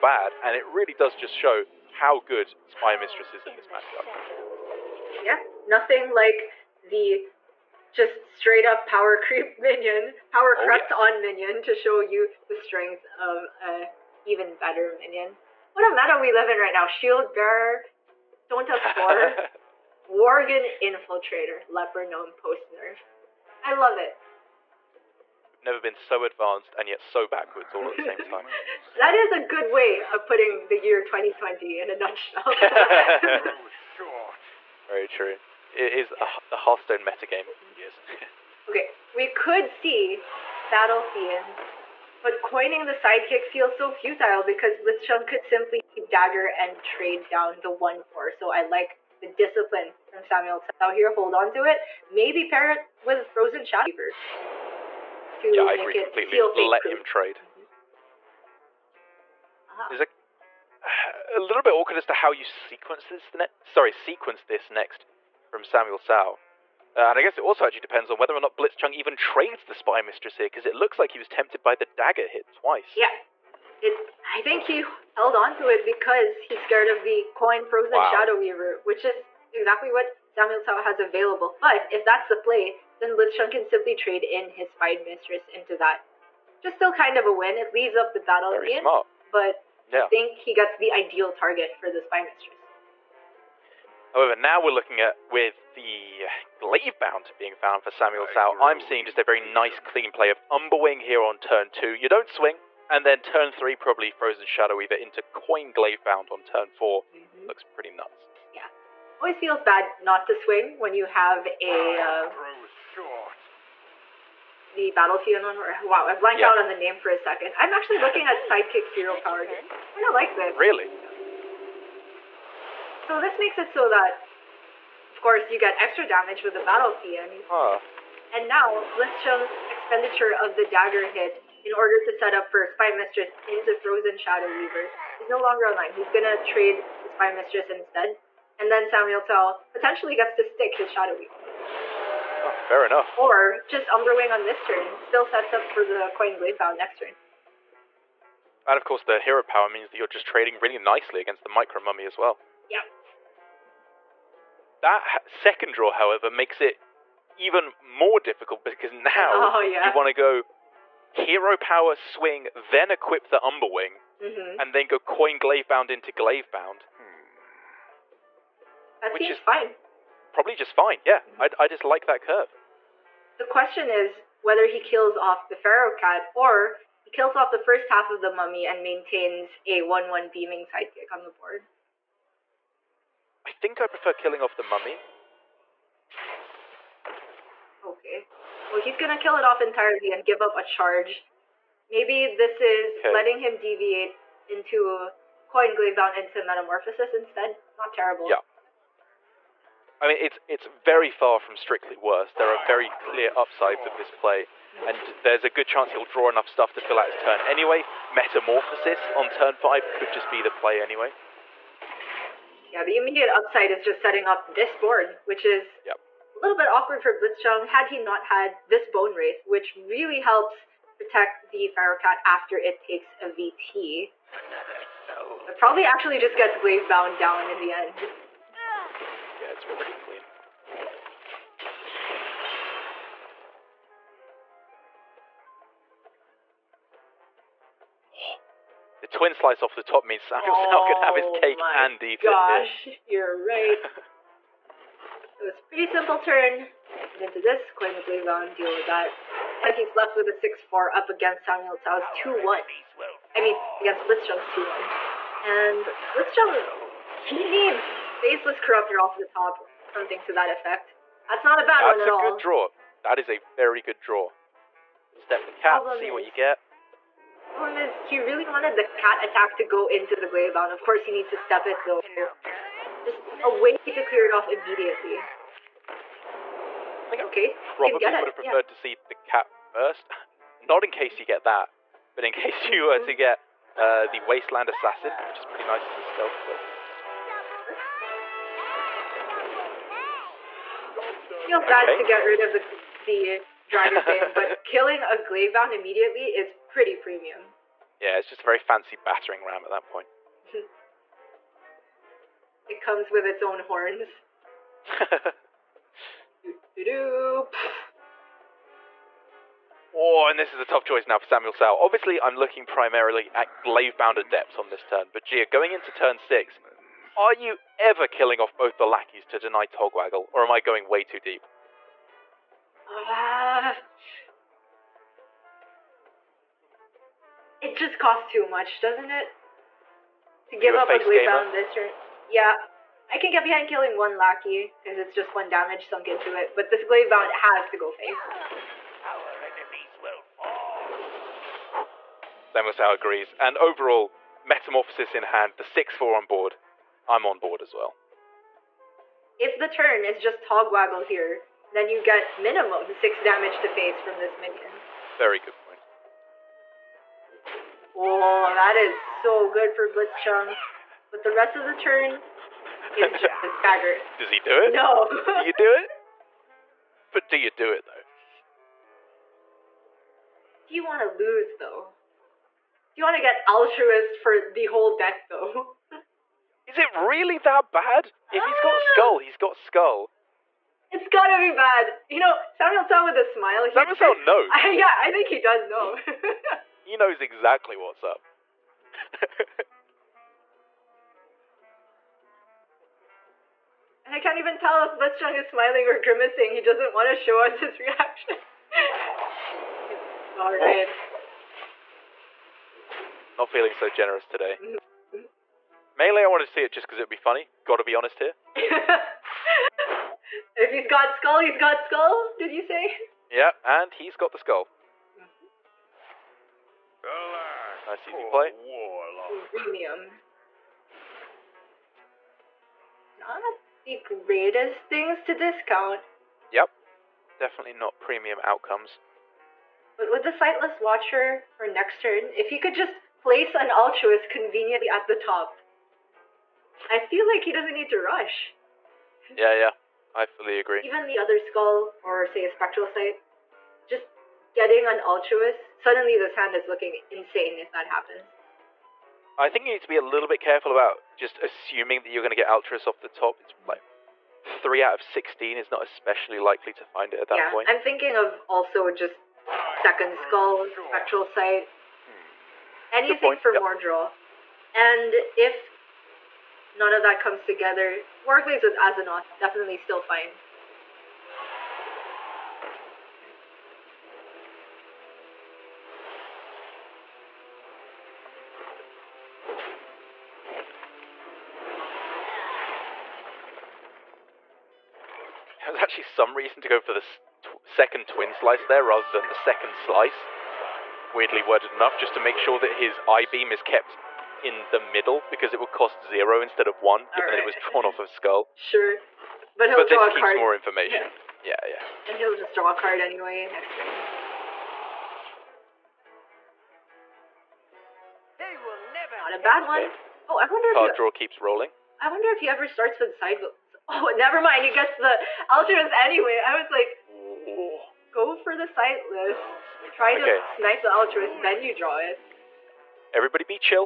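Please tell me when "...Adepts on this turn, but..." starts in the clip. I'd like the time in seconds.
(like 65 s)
314 s.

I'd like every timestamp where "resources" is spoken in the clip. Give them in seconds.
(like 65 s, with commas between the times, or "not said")
not said.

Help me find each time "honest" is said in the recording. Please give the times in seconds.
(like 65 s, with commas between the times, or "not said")
407 s.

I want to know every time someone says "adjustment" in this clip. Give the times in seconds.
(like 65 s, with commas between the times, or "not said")
not said.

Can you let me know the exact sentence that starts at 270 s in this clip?
Of course, he needs to step it though.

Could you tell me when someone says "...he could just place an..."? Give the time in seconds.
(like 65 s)
432 s.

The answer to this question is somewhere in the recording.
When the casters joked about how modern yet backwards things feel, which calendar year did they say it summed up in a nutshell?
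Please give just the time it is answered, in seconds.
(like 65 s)
31 s.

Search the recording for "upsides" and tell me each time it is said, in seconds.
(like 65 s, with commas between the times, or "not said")
203 s, 213 s.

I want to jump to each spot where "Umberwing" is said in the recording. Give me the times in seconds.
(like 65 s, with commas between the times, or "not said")
100 s, 143 s, 163 s.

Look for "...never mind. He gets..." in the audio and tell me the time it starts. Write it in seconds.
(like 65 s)
514 s.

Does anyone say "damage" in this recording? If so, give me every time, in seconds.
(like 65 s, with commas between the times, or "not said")
126 s, 335 s, 353 s.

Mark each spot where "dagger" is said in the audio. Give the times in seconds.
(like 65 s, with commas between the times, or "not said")
46 s, 71 s, 130 s.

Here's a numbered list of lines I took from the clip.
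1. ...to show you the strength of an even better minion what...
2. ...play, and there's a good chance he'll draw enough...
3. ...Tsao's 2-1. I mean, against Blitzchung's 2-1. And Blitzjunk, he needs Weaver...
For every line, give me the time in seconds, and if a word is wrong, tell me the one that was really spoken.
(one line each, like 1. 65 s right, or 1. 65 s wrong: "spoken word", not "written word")
1. 11 s right
2. 204 s right
3. 251 s wrong: "Faceless", not "Weaver".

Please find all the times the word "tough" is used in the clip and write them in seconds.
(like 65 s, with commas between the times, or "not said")
310 s.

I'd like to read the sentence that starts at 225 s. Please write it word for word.
But probably actually just gets bound down in the end.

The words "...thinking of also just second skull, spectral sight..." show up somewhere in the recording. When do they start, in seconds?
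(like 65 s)
457 s.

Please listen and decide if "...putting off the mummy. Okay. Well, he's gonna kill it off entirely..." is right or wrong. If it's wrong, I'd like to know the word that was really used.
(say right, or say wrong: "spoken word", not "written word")
wrong: "killing", not "putting".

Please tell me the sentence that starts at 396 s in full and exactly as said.
He doesn't want to show us his reaction.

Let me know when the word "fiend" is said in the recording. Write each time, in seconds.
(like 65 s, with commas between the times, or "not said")
41 s, 126 s.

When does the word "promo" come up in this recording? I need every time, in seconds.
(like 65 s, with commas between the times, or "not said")
not said.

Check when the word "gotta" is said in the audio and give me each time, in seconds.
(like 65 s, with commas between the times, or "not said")
381 s, 407 s.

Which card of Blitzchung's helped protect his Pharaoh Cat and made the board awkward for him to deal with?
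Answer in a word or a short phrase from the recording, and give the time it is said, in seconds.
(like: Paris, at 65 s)
Bone Wraith, at 218 s.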